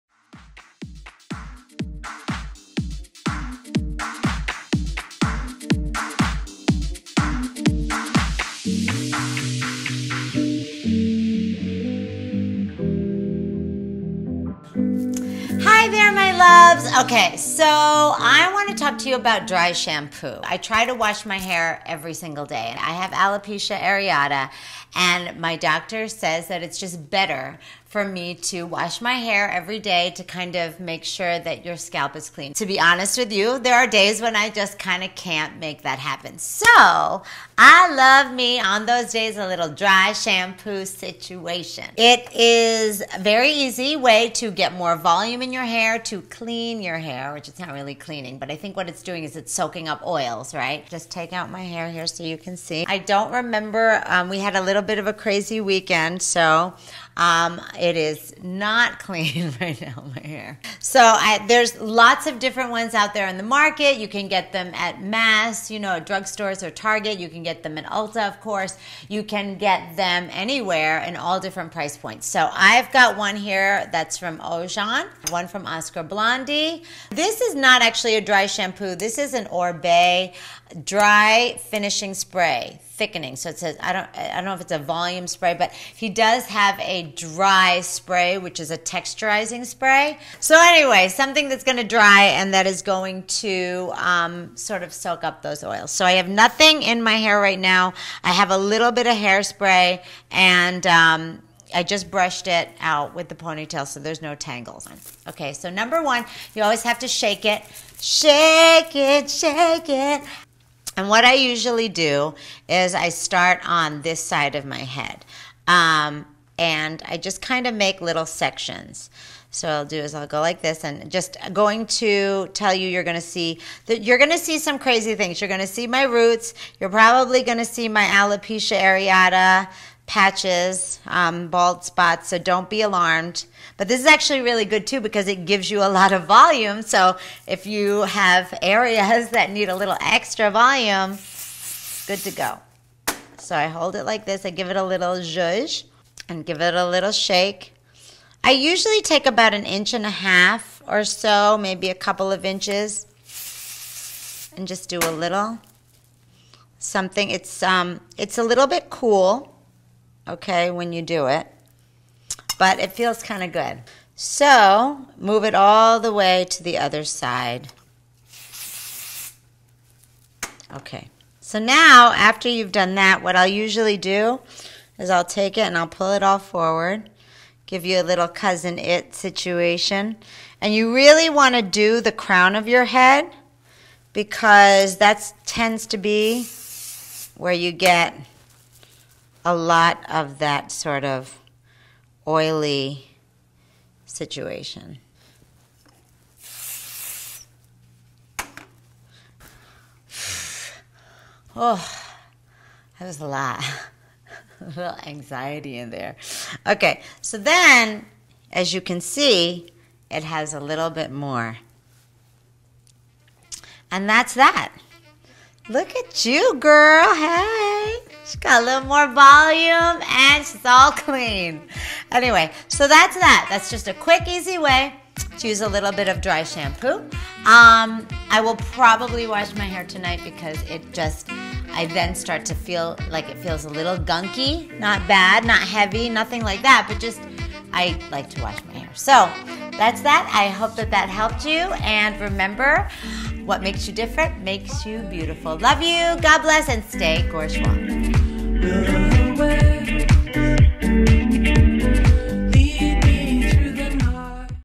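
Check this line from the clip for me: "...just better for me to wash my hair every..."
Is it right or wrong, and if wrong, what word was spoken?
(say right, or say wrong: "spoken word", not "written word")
right.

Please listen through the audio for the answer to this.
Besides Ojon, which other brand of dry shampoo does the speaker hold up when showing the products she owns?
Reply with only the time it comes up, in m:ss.
1:15.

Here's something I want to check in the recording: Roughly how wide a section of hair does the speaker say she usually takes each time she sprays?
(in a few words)
an inch and a half.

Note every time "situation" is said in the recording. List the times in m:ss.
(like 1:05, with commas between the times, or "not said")
0:40, 2:59, 3:14.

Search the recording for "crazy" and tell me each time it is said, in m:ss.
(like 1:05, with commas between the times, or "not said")
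0:55, 2:04.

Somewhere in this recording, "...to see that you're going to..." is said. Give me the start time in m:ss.
2:03.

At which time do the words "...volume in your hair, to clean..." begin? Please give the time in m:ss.
0:44.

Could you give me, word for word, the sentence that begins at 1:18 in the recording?
This is an Oribe dry finishing spray thickening.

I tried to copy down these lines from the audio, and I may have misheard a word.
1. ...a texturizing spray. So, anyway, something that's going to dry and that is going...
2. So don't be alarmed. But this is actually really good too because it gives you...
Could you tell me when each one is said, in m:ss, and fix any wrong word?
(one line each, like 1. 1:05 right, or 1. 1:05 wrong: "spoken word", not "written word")
1. 1:28 right
2. 2:12 right.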